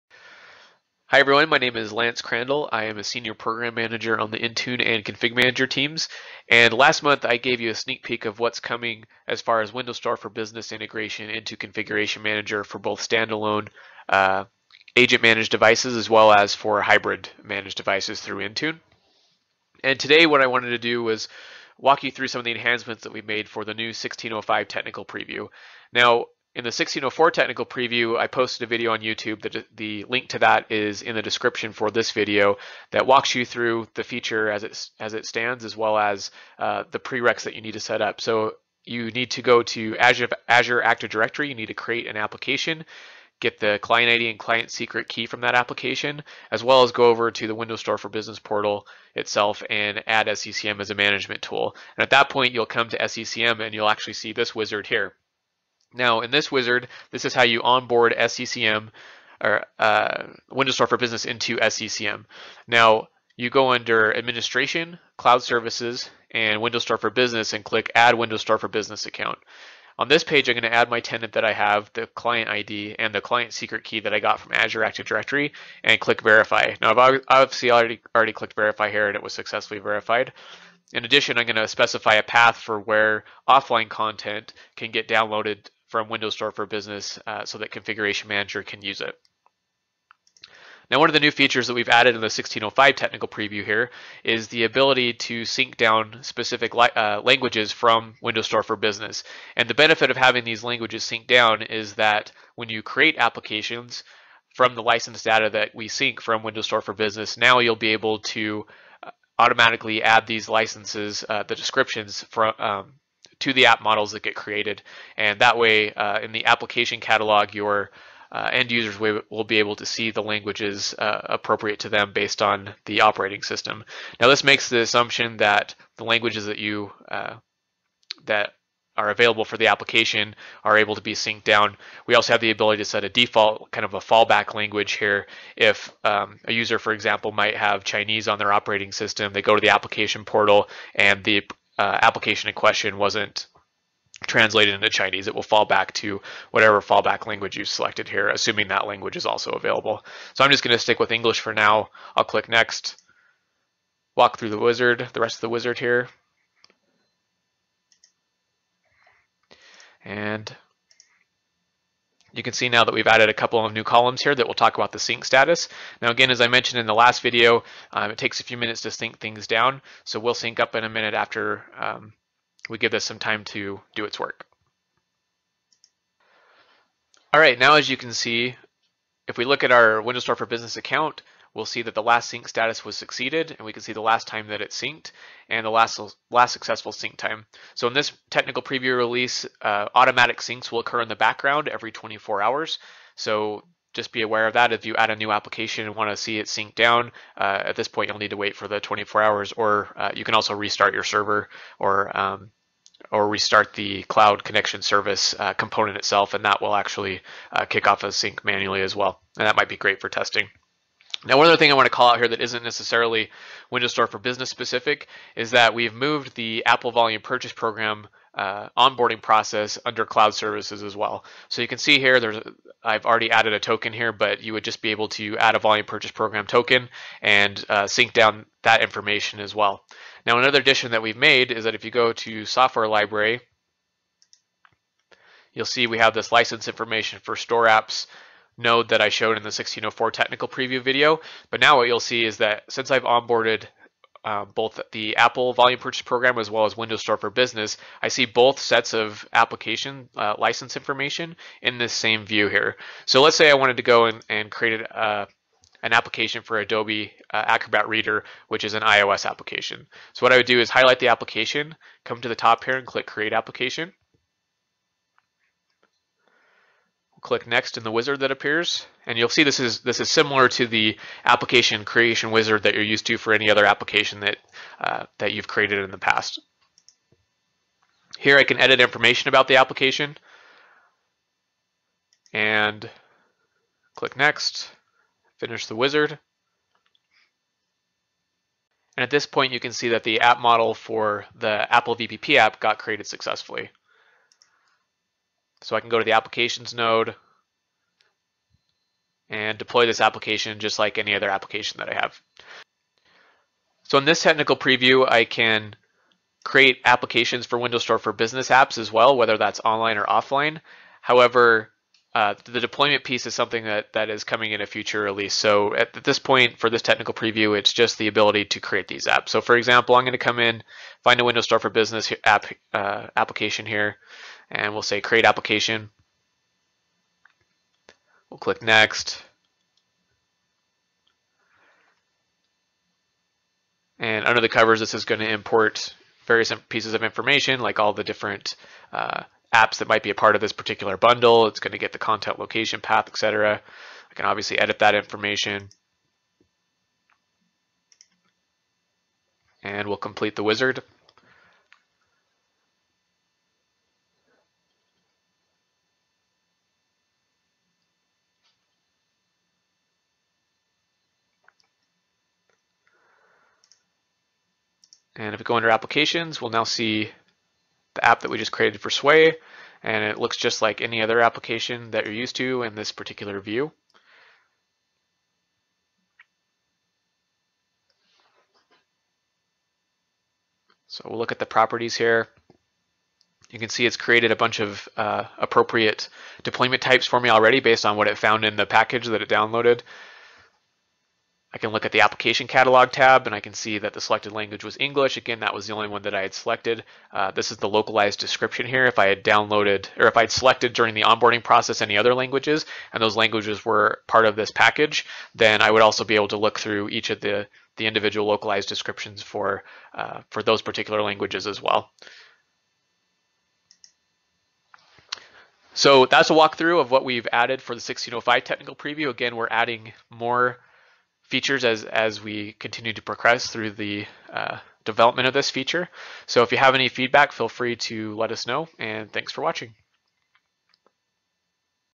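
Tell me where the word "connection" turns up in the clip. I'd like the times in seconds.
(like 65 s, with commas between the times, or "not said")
204 s.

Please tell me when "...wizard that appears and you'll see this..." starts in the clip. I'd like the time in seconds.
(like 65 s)
267 s.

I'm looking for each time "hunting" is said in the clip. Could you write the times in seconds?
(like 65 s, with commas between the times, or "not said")
not said.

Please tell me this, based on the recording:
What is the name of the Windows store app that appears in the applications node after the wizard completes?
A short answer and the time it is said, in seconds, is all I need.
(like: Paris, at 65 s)
Sway, at 368 s.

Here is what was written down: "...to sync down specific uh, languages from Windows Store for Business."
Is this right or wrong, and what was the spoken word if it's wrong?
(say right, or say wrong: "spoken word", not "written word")
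right.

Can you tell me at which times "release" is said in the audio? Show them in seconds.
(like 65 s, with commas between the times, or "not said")
188 s, 315 s.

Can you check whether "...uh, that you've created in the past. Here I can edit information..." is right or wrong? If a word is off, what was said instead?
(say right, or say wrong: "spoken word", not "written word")
right.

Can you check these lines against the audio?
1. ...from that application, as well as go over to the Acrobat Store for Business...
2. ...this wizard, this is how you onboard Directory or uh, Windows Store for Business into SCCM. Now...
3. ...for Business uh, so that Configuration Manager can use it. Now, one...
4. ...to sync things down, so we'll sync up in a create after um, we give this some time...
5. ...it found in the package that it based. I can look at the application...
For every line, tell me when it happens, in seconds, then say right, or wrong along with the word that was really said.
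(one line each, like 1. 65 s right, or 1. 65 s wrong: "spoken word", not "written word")
1. 45 s wrong: "Windows", not "Acrobat"
2. 56 s wrong: "SCCM", not "Directory"
3. 86 s right
4. 168 s wrong: "minute", not "create"
5. 388 s wrong: "downloaded", not "based".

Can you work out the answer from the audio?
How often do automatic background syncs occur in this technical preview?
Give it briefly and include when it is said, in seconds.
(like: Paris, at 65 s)
Every 24 hours, at 191 s.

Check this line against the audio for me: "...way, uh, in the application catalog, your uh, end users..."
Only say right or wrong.
right.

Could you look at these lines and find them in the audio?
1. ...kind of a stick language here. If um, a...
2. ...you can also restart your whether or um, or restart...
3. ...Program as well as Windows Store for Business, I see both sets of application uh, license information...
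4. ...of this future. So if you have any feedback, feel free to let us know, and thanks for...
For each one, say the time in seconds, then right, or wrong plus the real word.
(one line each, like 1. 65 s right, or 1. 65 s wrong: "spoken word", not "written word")
1. 133 s wrong: "fallback", not "stick"
2. 200 s wrong: "server", not "whether"
3. 246 s right
4. 425 s wrong: "feature", not "future".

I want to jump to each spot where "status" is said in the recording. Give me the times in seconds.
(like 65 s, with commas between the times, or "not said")
165 s, 182 s.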